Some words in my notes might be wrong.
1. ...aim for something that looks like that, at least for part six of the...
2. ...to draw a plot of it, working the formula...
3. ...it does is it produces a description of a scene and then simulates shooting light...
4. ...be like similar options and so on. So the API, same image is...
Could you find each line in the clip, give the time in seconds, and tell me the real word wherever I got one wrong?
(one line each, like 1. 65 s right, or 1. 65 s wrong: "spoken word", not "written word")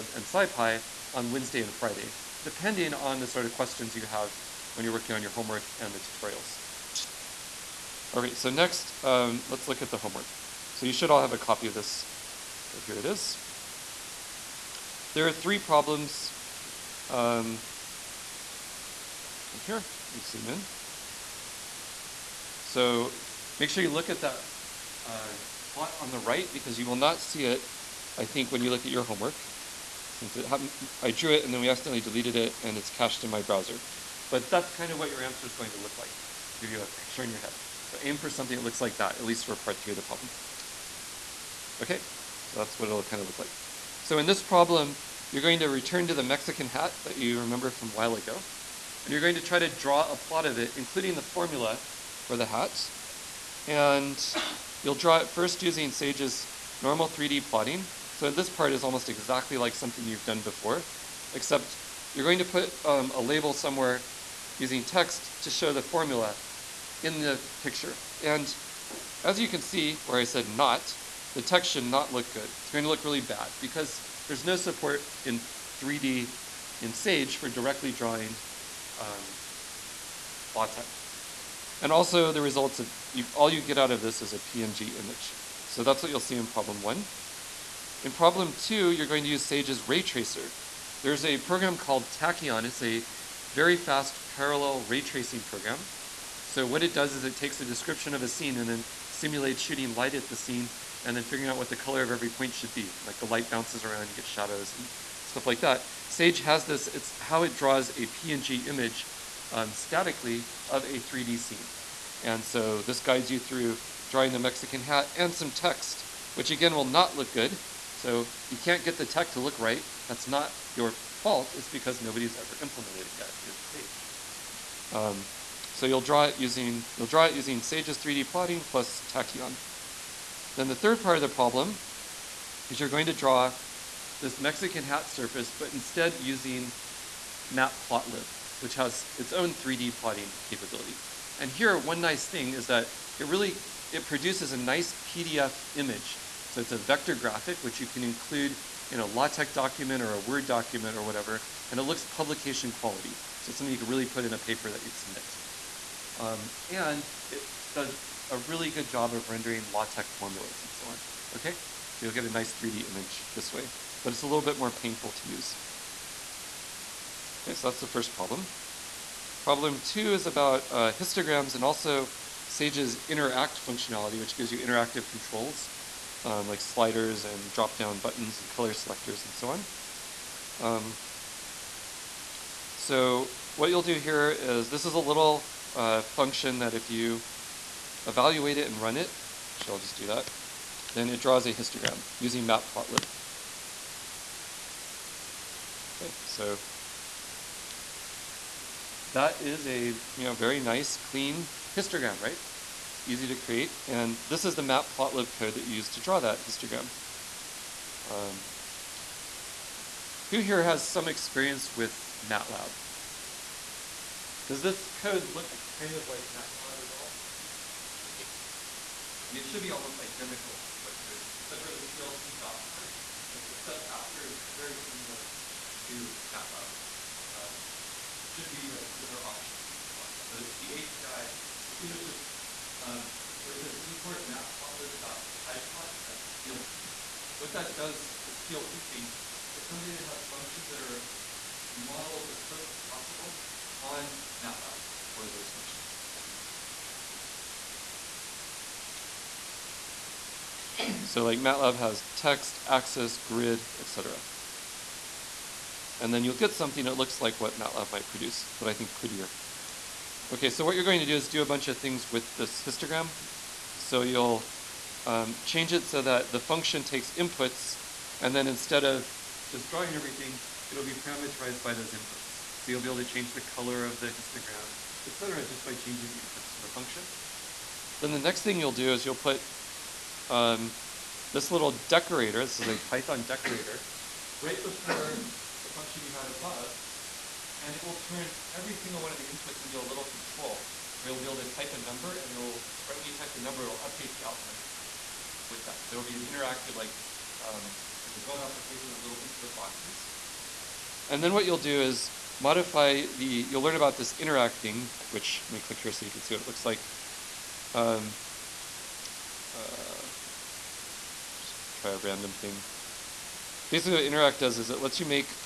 1. 38 s wrong: "three", not "six"
2. 49 s wrong: "including", not "working"
3. 96 s wrong: "takes", not "produces"
4. 228 s right.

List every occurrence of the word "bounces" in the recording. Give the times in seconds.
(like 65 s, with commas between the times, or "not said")
103 s.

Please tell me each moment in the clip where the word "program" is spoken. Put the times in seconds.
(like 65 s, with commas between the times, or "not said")
91 s, 95 s.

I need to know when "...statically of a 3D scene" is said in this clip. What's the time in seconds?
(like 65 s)
109 s.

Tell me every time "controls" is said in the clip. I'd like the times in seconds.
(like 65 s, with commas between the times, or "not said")
175 s, 290 s.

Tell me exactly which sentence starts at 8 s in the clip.
Okay, so next, um, let's look at the homework.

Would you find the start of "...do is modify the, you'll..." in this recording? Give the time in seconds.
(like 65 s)
301 s.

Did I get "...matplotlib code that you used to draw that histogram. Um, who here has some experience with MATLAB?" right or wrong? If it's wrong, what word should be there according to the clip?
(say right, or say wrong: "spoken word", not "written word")
right.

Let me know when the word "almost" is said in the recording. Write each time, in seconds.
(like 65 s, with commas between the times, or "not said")
58 s, 219 s.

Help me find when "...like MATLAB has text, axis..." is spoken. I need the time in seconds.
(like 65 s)
251 s.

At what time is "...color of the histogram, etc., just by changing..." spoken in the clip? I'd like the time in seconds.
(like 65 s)
273 s.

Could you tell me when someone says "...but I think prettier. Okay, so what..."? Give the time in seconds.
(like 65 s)
258 s.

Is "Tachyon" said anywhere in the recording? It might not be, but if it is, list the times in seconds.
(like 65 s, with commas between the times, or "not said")
92 s, 129 s.